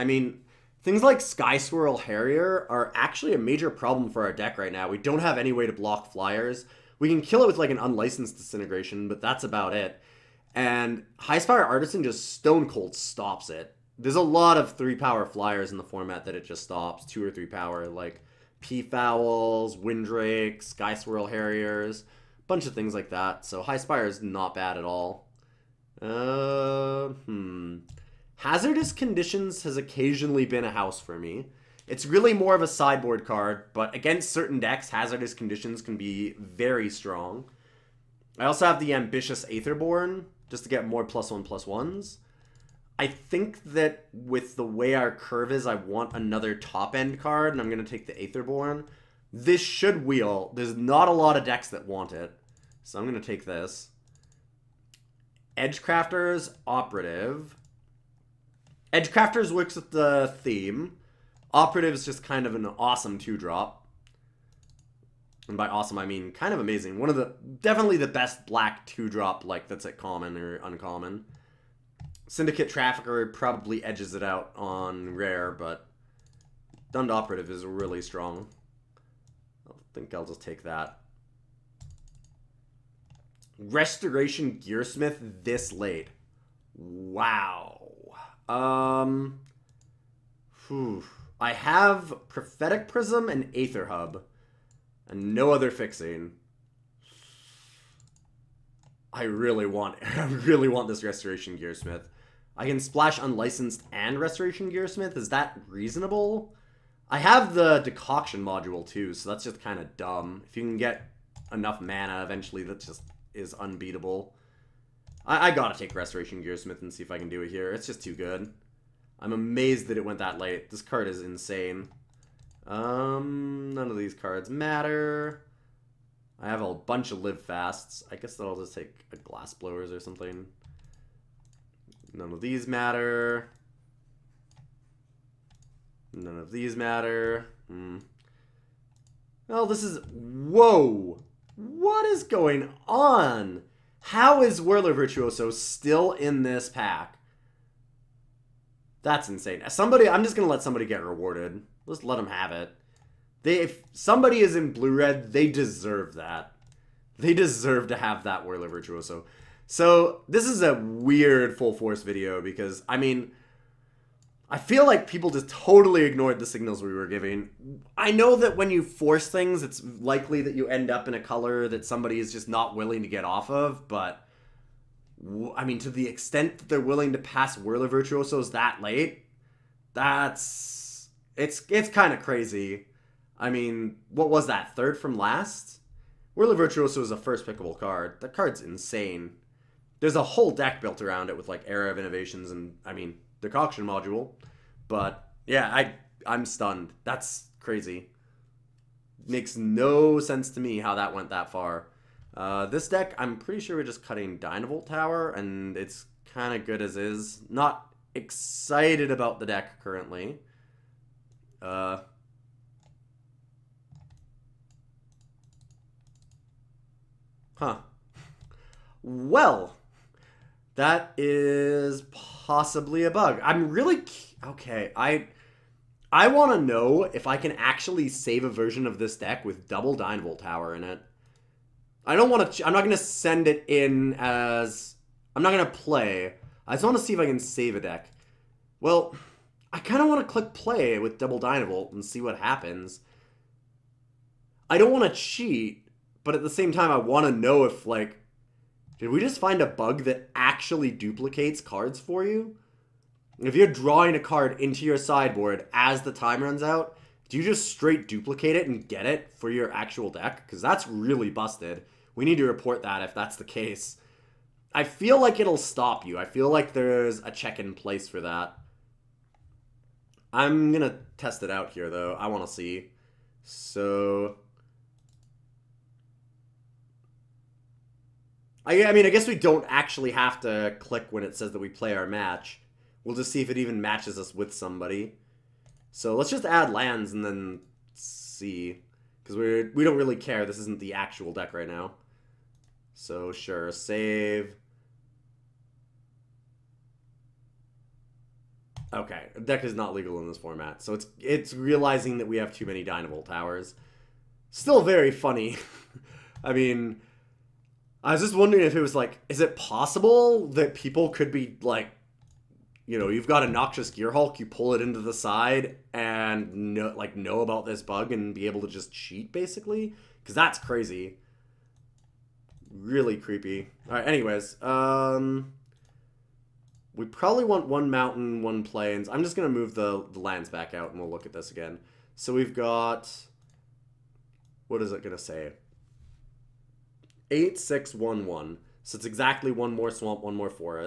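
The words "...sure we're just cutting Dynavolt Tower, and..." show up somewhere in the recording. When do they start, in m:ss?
3:23.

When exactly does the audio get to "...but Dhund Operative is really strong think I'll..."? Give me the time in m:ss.
1:15.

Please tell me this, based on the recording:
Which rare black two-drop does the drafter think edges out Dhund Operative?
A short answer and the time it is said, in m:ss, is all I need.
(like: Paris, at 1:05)
Syndicate Trafficker, at 1:12.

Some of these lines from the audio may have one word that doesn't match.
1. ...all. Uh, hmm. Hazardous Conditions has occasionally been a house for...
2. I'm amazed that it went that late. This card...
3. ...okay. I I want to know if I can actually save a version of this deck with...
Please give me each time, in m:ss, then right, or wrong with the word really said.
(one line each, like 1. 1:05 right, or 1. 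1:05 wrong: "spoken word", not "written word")
1. 0:24 right
2. 1:59 right
3. 3:44 right.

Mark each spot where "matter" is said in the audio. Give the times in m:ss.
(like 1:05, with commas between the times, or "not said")
2:04, 2:12, 2:16.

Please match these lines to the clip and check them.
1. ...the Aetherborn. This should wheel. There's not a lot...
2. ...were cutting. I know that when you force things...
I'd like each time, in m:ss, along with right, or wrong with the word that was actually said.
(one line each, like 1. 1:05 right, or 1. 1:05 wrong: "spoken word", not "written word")
1. 0:48 right
2. 2:46 wrong: "giving", not "cutting".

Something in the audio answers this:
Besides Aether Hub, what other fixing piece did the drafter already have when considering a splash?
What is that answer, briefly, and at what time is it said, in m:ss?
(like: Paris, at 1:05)
Prophetic Prism, at 1:32.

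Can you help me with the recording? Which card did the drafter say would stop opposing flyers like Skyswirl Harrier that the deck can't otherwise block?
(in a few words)
High Spire Artisan.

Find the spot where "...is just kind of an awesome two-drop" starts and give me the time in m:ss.
1:01.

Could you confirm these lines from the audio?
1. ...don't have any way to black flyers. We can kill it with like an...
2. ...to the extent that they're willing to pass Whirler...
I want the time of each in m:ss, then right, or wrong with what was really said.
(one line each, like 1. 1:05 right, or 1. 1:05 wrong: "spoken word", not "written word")
1. 0:04 wrong: "block", not "black"
2. 2:55 right.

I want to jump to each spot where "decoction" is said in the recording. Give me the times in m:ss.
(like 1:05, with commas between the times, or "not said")
1:47, 3:13.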